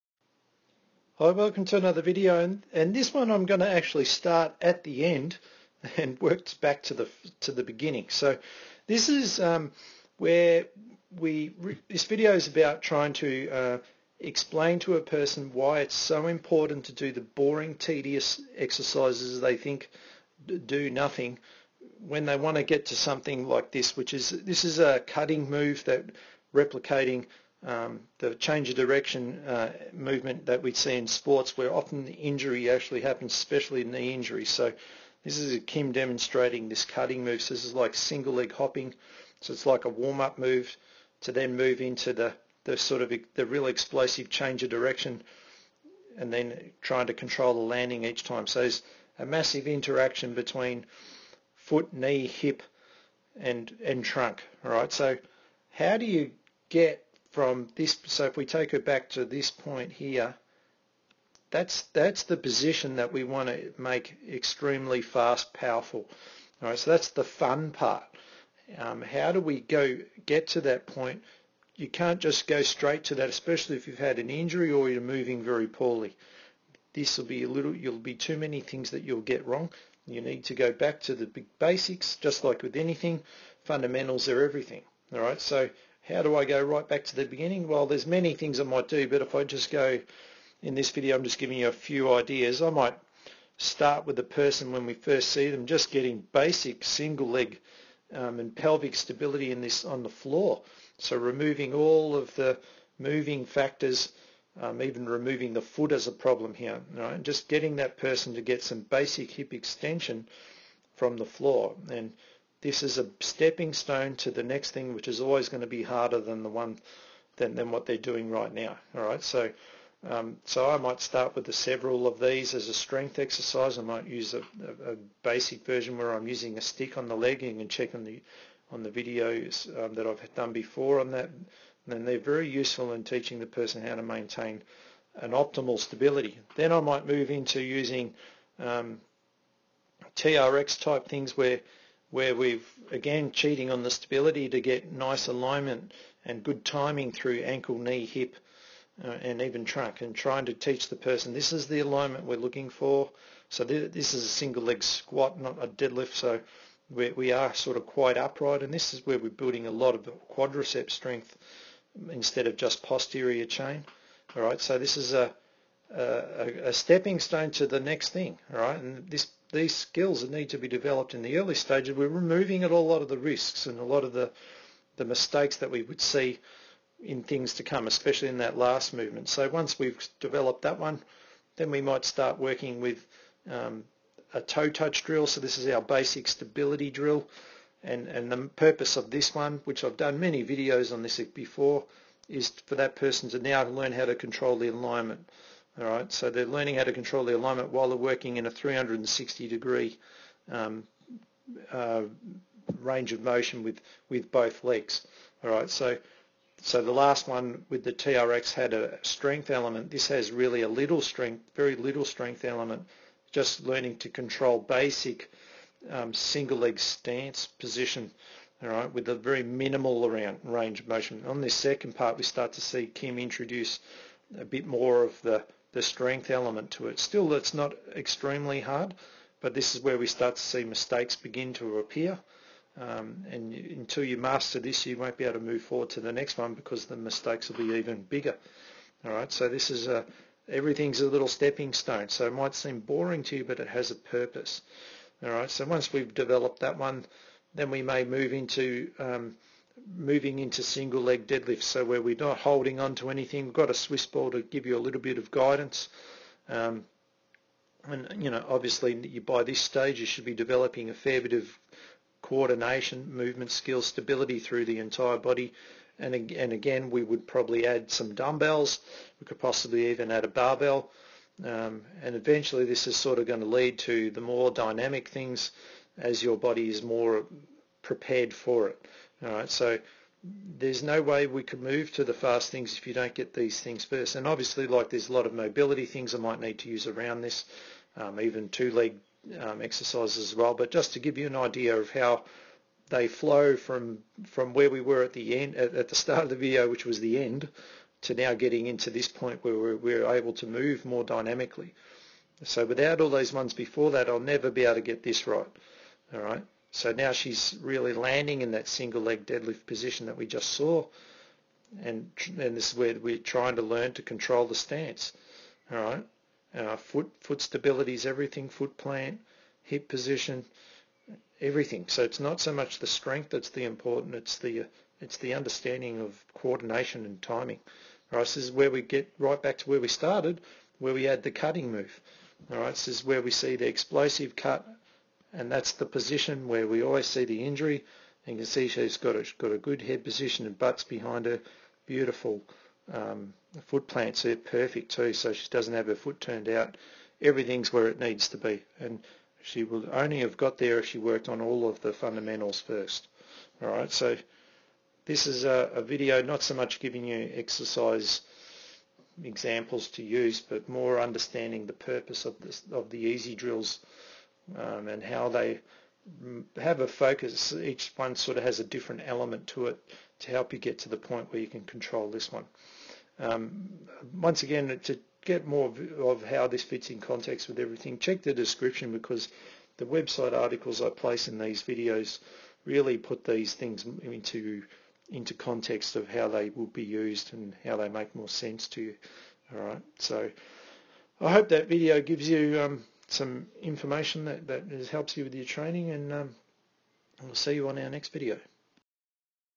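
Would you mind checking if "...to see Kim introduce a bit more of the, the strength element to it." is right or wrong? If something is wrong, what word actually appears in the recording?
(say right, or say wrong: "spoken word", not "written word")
right.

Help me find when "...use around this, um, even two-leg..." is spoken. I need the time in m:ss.
4:46.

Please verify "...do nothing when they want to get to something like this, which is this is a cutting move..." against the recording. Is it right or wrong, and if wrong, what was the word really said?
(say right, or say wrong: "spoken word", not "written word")
right.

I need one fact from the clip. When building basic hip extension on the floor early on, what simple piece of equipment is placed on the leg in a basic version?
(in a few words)
a stick.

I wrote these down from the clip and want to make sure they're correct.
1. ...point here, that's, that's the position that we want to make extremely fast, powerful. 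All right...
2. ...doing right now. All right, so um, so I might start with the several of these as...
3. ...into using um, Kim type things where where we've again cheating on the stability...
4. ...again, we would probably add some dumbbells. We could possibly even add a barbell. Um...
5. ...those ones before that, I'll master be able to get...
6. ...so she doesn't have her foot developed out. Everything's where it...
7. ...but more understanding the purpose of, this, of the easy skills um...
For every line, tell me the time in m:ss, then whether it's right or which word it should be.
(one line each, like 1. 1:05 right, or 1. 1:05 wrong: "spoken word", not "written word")
1. 0:59 right
2. 1:57 right
3. 2:17 wrong: "TRX", not "Kim"
4. 4:26 right
5. 5:03 wrong: "never", not "master"
6. 5:45 wrong: "turned", not "developed"
7. 6:00 wrong: "drills", not "skills".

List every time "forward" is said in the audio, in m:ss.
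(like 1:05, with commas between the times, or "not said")
3:55.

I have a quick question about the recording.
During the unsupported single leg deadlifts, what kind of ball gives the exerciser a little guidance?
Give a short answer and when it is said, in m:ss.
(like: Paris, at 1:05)
Swiss ball, at 4:13.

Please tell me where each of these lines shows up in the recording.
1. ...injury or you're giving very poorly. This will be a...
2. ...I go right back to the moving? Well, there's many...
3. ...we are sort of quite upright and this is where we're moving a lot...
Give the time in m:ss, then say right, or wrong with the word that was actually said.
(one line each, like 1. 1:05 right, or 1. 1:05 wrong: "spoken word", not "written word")
1. 1:14 wrong: "moving", not "giving"
2. 1:26 wrong: "beginning", not "moving"
3. 2:37 wrong: "building", not "moving".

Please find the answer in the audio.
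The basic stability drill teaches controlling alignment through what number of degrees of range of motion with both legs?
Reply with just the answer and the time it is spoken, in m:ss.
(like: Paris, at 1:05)
360, at 3:18.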